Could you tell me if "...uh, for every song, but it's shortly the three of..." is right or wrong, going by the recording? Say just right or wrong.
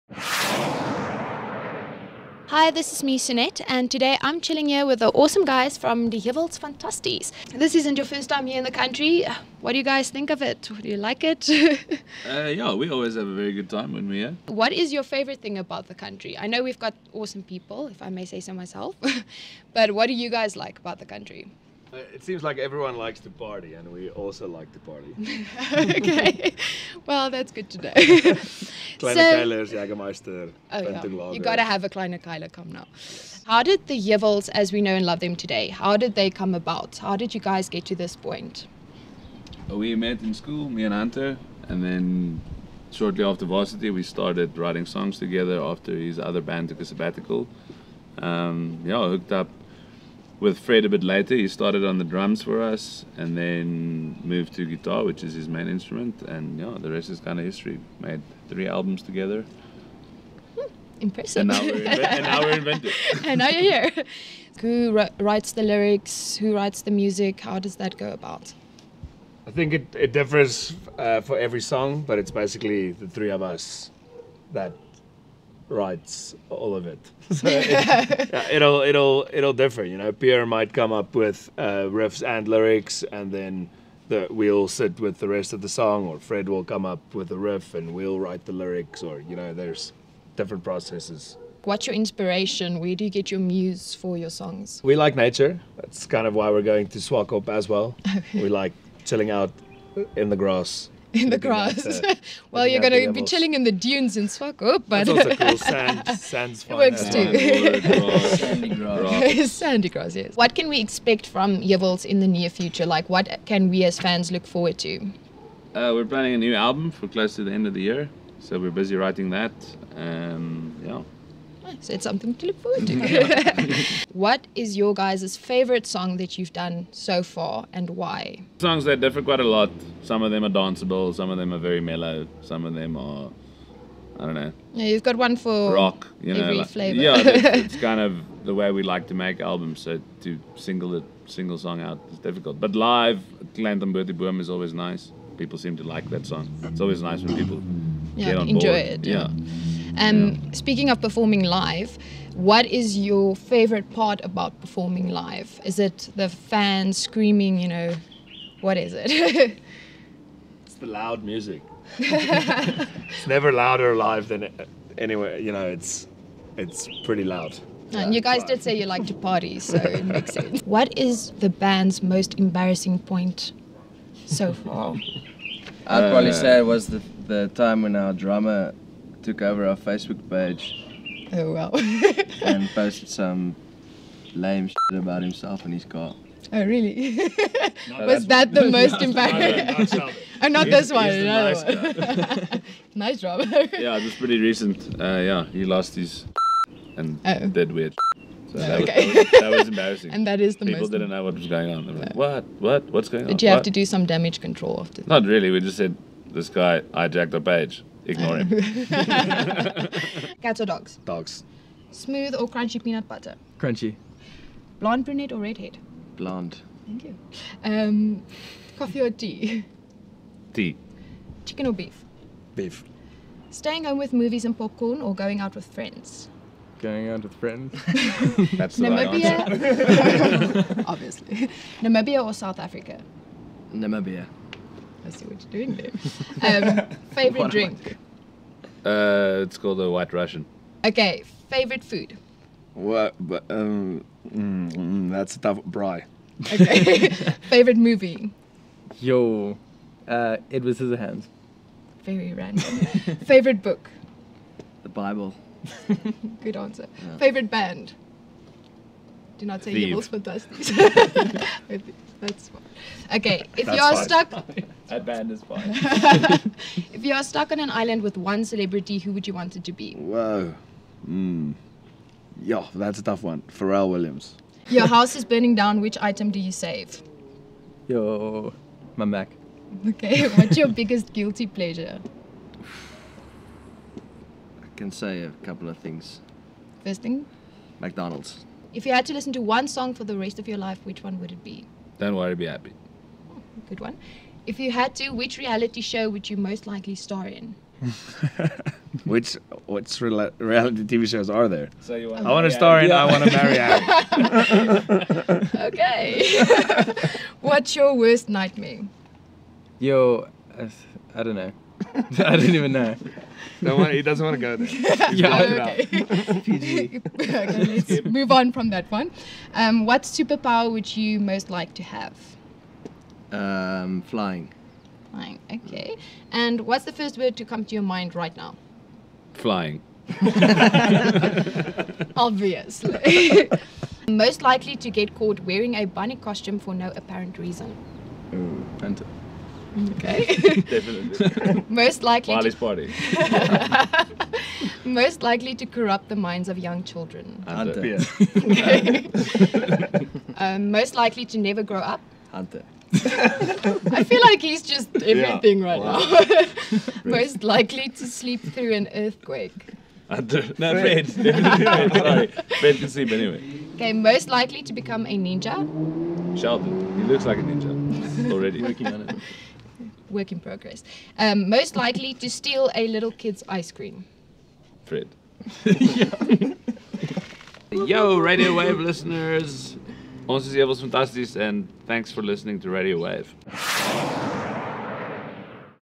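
wrong.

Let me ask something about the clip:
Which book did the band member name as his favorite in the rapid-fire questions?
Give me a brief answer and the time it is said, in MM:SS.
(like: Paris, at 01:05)
The Bible, at 04:14.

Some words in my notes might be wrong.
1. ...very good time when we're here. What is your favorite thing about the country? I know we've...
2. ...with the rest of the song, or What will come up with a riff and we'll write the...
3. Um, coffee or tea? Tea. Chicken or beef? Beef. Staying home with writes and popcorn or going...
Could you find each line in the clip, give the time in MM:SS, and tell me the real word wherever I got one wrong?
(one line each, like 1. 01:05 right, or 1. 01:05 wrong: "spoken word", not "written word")
1. 00:13 right
2. 01:24 wrong: "Fred", not "What"
3. 03:37 wrong: "movies", not "writes".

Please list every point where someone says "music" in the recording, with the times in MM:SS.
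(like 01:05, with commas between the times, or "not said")
01:06, 02:41.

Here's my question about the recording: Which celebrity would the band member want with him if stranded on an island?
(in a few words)
Pharrell Williams.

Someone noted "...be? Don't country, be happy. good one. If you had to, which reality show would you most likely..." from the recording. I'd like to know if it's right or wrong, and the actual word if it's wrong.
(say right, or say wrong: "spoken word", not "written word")
wrong: "worry", not "country".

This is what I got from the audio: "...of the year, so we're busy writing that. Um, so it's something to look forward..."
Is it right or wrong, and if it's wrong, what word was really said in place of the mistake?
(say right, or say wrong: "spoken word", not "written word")
right.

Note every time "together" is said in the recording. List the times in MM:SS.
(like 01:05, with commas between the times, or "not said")
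00:45, 00:59.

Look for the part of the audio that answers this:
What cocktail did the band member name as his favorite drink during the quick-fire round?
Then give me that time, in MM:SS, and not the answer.
03:59.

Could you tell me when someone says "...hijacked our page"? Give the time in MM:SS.
03:26.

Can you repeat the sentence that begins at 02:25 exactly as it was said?
People seem to like that song.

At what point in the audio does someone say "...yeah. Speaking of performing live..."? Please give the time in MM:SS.
02:30.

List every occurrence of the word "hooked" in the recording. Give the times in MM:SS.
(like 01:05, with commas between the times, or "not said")
00:49.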